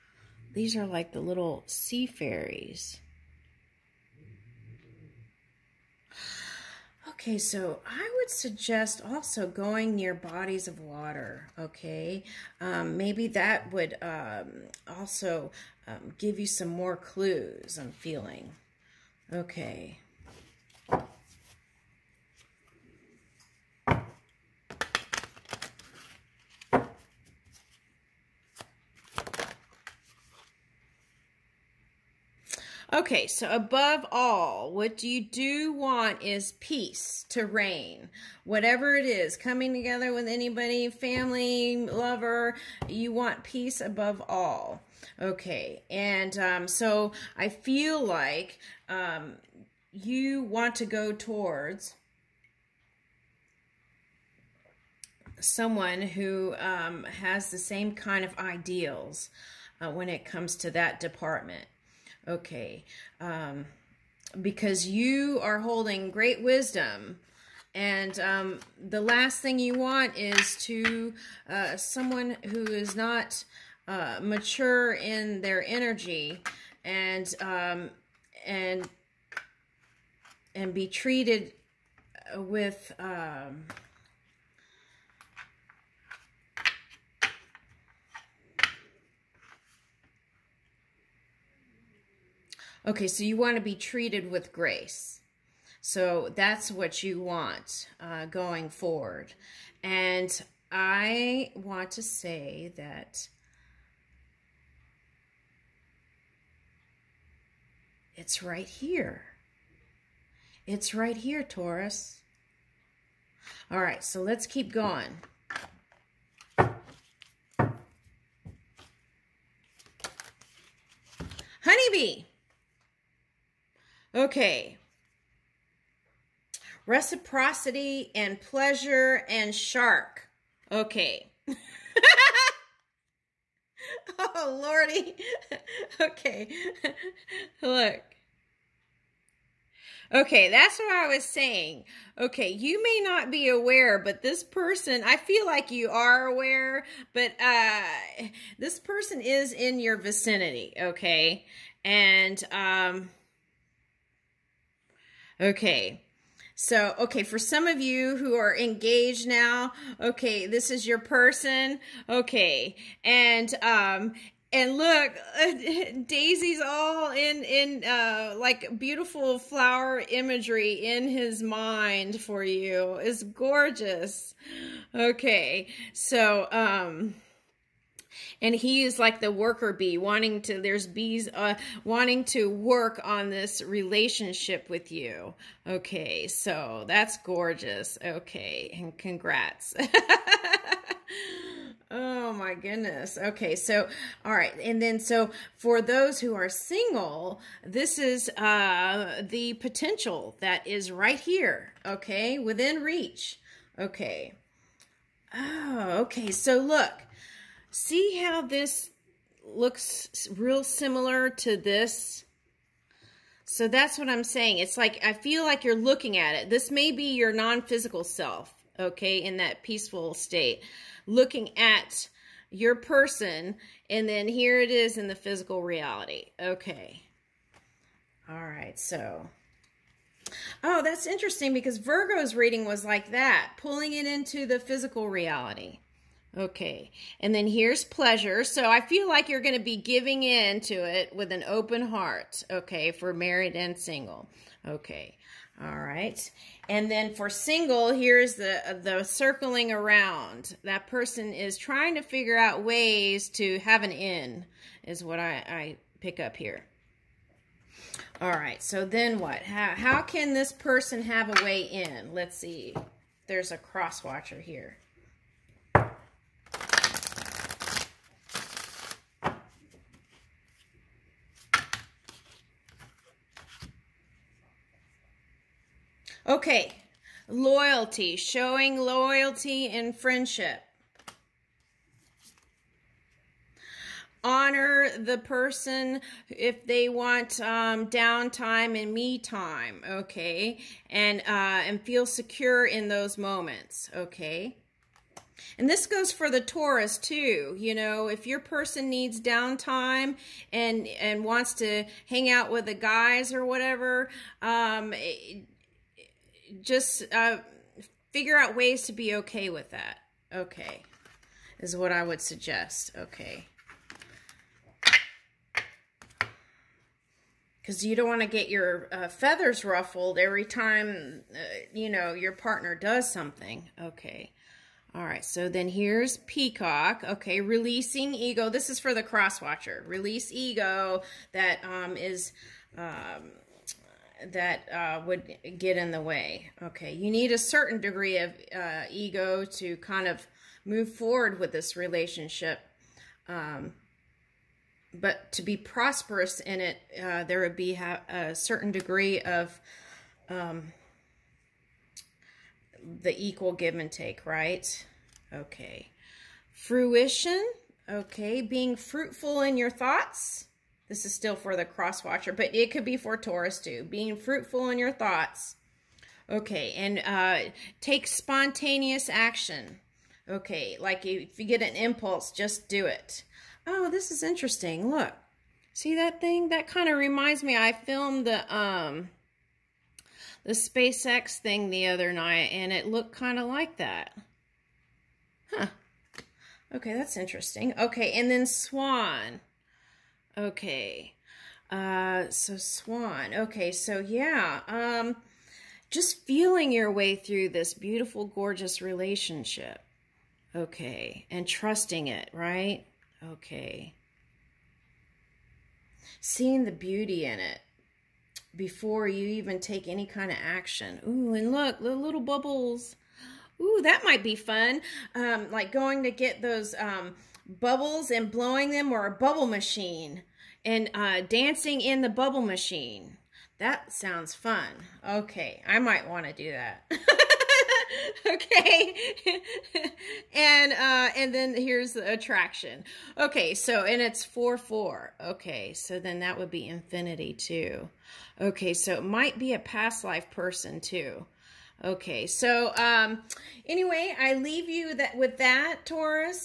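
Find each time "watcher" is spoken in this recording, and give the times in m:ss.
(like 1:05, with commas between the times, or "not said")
4:24, 5:29, 6:02.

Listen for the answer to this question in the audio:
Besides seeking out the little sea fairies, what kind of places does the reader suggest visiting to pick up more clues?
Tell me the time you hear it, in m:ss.
0:10.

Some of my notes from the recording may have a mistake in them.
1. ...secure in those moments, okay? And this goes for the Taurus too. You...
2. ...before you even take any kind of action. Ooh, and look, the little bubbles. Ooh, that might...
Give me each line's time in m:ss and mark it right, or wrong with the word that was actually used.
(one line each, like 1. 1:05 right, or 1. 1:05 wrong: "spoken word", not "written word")
1. 4:52 right
2. 6:48 right.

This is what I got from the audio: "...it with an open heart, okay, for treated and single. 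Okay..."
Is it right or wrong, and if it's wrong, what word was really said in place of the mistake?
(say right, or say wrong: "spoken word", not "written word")
wrong: "married", not "treated".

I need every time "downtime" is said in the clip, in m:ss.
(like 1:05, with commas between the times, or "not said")
4:47, 4:59.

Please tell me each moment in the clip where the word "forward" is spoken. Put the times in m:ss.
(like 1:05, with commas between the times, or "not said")
1:38, 5:40.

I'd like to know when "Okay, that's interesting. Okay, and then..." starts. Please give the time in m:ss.
6:26.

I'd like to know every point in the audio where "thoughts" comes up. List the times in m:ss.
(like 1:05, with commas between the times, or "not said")
5:59, 6:04.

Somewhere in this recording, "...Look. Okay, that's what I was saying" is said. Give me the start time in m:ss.
2:17.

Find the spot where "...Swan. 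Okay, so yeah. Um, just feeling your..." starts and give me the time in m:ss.
6:32.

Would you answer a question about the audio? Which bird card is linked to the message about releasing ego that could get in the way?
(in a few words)
Peacock.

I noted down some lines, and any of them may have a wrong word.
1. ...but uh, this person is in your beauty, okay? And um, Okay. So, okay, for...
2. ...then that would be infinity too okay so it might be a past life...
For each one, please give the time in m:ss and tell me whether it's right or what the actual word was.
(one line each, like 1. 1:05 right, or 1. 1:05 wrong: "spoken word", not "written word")
1. 2:27 wrong: "vicinity", not "beauty"
2. 7:15 right.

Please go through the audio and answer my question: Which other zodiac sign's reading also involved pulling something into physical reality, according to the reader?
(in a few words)
Virgo.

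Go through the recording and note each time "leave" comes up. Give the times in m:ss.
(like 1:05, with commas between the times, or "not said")
7:24.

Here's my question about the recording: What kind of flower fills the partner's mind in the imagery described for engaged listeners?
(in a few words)
Daisy.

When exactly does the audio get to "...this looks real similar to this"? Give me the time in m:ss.
3:28.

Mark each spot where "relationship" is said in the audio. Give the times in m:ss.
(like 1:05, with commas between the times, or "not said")
3:03, 5:41, 6:38.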